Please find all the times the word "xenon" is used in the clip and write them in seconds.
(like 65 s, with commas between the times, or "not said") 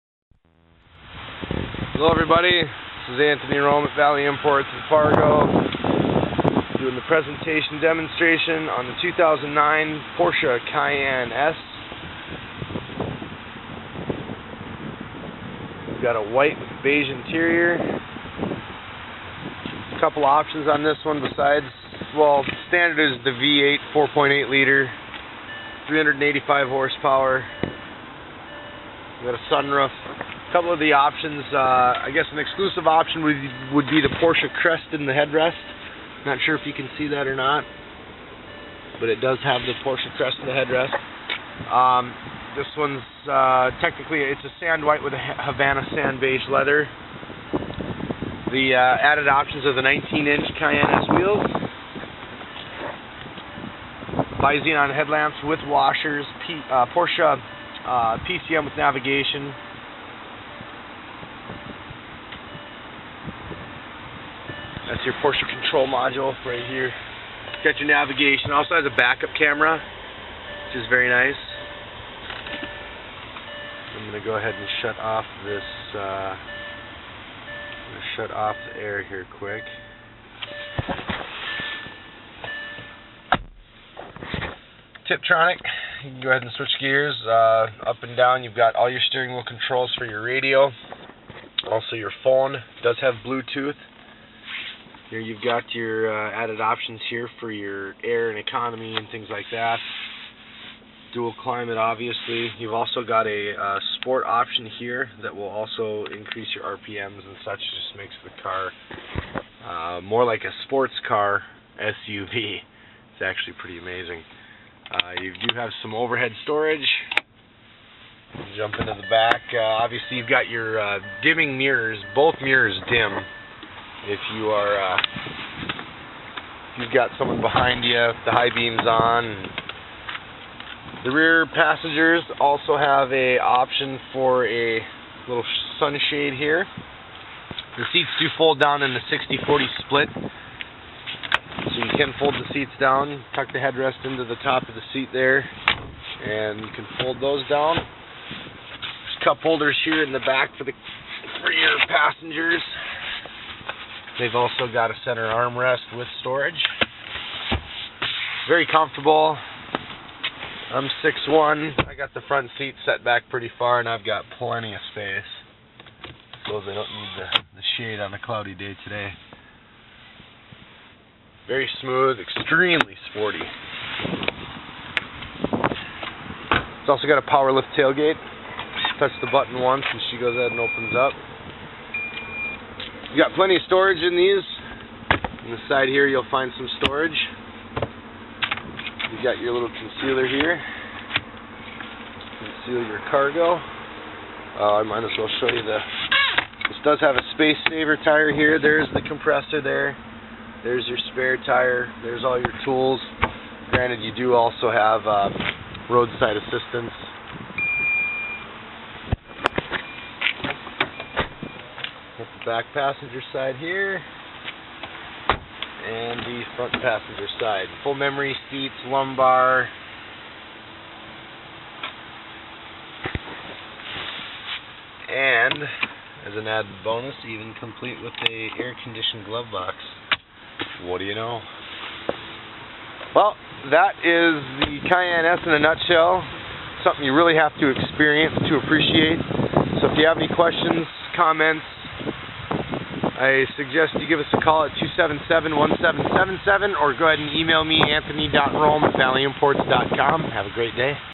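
54 s.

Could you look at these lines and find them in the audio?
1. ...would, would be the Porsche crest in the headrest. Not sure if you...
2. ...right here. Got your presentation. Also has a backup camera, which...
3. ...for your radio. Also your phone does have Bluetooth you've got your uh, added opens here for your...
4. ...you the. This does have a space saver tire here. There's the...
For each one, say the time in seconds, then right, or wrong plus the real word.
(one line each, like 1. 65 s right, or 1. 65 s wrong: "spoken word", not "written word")
1. 33 s right
2. 66 s wrong: "navigation", not "presentation"
3. 89 s wrong: "options", not "opens"
4. 195 s right.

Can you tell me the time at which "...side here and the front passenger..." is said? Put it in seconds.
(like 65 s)
213 s.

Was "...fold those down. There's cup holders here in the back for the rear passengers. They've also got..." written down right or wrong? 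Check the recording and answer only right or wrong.
right.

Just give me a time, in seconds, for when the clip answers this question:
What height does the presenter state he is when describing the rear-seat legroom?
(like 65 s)
161 s.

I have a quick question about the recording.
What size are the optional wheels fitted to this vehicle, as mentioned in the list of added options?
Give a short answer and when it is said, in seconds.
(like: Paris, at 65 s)
19-inch, at 49 s.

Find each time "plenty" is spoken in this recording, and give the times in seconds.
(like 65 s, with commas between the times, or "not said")
164 s, 183 s.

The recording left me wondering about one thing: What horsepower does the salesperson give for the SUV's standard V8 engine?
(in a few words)
385.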